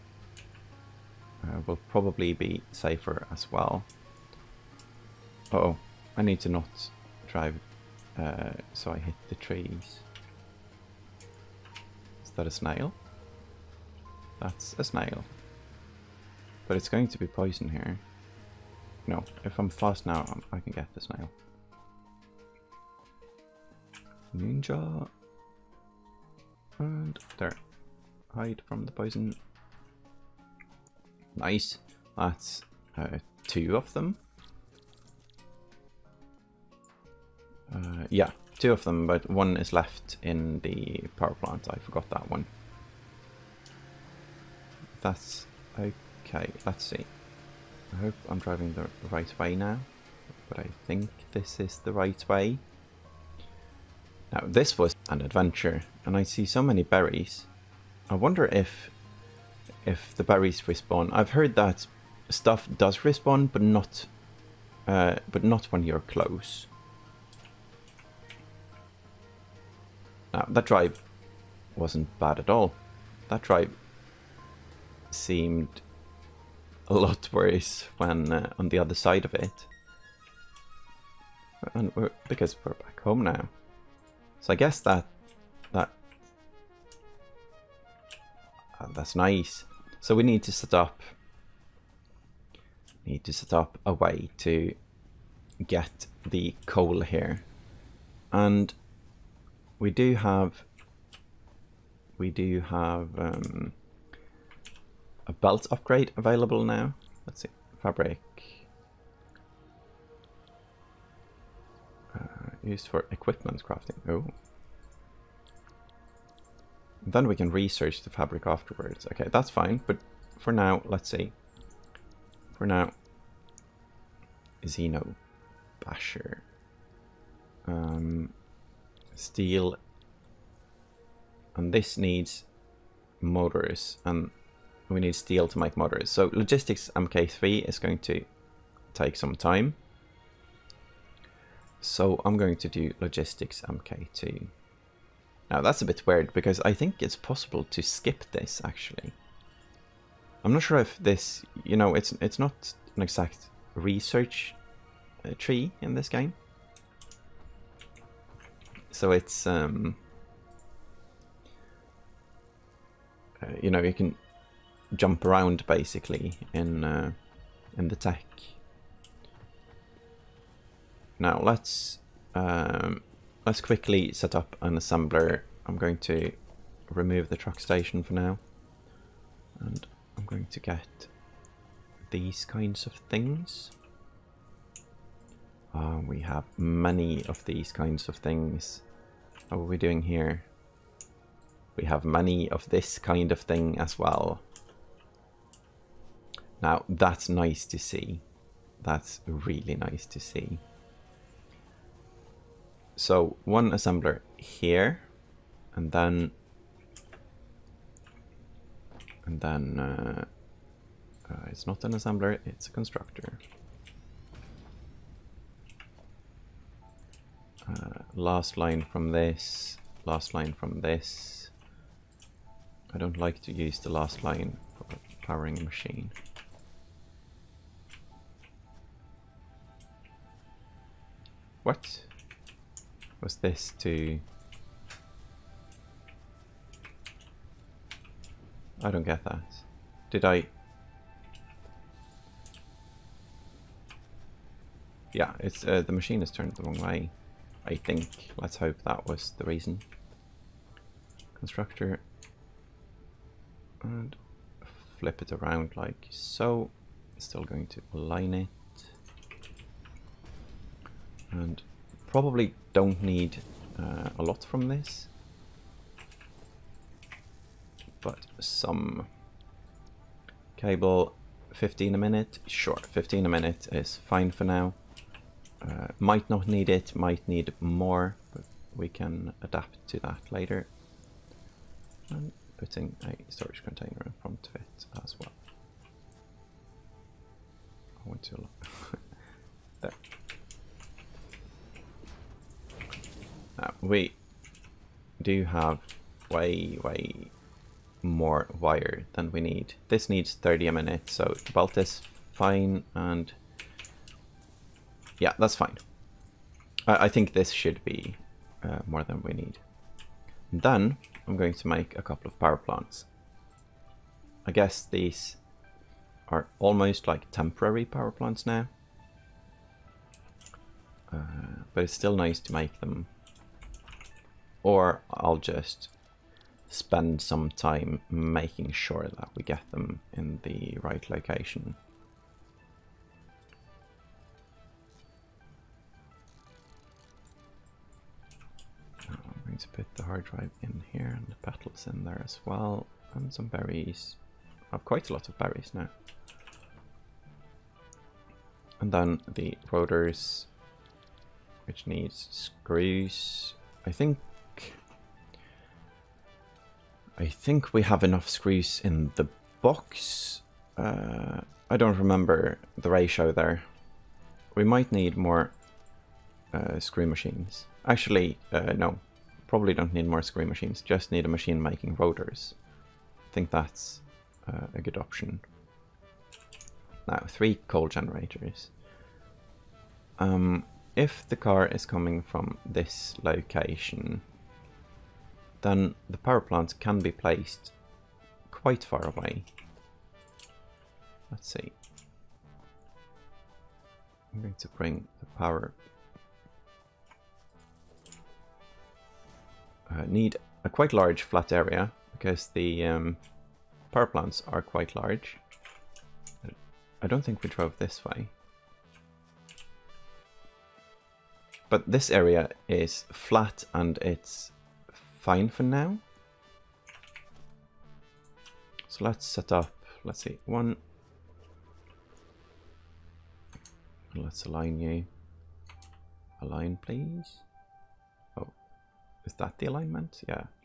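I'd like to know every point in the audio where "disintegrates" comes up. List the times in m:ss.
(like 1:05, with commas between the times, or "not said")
not said.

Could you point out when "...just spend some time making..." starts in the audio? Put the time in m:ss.
5:25.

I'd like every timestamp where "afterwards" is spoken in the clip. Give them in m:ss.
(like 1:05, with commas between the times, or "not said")
1:58.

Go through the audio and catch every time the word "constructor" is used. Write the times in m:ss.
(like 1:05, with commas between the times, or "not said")
3:32, 4:11.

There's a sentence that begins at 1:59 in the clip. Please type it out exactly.
Okay, that's fine, but for now, let's see.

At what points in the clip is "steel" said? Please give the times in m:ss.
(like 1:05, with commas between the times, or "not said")
2:09, 2:15.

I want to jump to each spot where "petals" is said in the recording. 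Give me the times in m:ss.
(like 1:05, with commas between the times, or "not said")
5:41.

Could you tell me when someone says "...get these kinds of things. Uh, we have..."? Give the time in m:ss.
3:00.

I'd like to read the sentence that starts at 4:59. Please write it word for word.
This needs 30 a minute, so belt is fine, and yeah, that's fine.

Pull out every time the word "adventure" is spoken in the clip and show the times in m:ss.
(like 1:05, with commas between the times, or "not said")
0:55.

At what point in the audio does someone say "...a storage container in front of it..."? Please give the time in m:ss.
4:43.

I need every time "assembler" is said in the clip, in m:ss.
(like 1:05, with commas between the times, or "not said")
2:54, 3:23, 3:31.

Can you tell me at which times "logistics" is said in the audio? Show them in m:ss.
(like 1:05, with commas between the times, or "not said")
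2:16, 2:22.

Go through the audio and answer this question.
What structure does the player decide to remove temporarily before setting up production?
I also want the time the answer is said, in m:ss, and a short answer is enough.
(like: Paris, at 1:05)
Truck station, at 2:57.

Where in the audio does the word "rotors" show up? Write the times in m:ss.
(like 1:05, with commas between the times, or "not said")
5:49, 6:11.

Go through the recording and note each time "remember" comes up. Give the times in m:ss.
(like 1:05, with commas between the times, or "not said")
6:01.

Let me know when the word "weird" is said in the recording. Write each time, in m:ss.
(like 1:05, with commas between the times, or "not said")
2:26.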